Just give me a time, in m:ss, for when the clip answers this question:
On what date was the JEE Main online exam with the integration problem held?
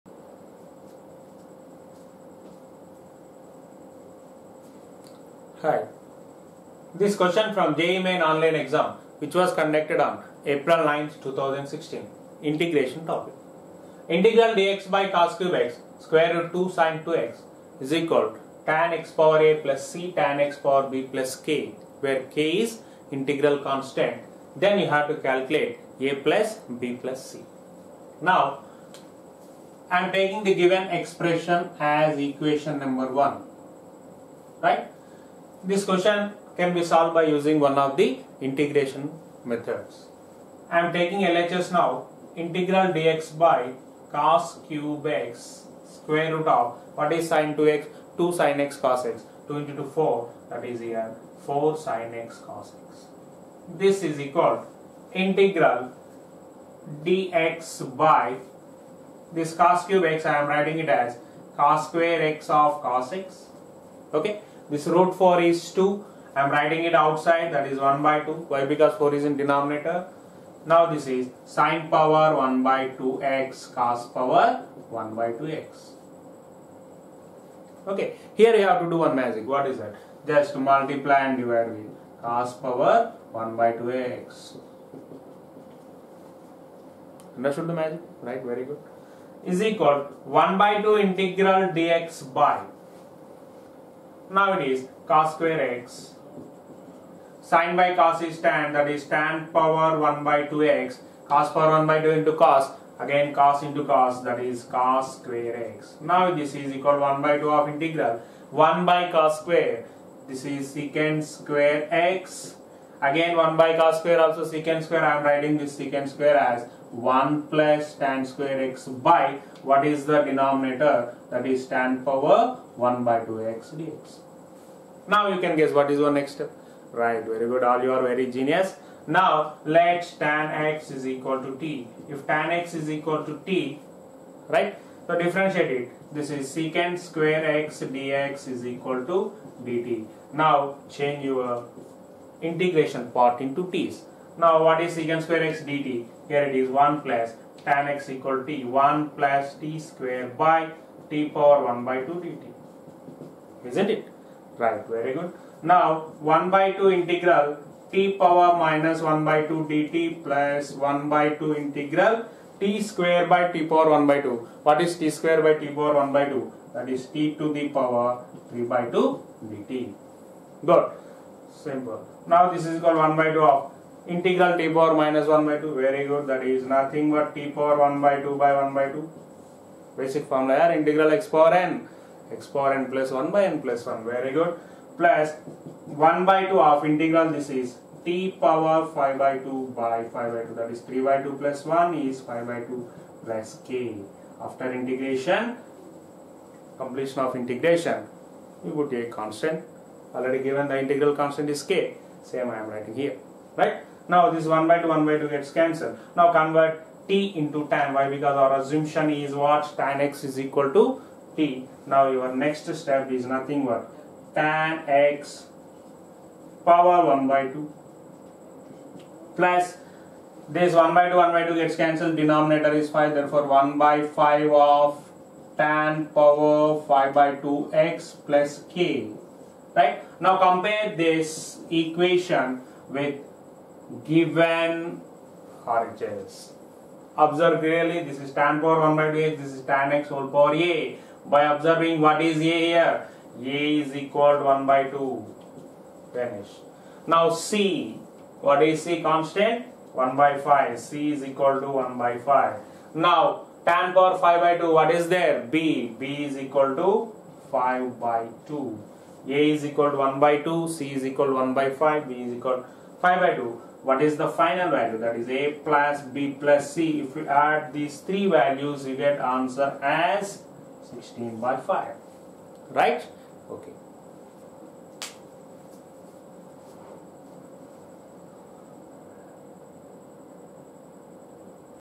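0:10.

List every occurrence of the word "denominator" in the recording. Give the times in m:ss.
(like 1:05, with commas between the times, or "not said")
1:09, 2:00, 3:42.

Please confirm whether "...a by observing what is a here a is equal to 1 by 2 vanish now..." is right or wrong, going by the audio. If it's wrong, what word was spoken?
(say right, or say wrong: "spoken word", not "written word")
right.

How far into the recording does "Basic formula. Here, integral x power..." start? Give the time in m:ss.
2:59.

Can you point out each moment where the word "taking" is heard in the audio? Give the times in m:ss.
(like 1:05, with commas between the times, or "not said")
0:30, 0:40.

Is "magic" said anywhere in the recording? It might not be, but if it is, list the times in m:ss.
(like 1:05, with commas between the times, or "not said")
1:19, 1:27.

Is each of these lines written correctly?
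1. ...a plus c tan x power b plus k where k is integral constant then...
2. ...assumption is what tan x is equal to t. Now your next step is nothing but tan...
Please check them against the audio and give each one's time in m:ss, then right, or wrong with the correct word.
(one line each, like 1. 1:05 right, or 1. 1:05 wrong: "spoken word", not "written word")
1. 0:19 right
2. 3:28 right.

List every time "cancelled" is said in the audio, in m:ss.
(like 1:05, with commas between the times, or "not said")
3:25, 3:41.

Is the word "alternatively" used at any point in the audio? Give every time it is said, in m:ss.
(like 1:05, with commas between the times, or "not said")
not said.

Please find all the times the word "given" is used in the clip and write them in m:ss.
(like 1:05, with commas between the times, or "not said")
0:30, 3:20, 3:54.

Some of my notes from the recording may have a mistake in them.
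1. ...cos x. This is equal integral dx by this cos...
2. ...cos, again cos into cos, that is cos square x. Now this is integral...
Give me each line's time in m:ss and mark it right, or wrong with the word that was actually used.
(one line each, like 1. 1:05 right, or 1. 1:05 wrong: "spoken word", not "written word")
1. 0:52 right
2. 1:42 wrong: "equal", not "integral".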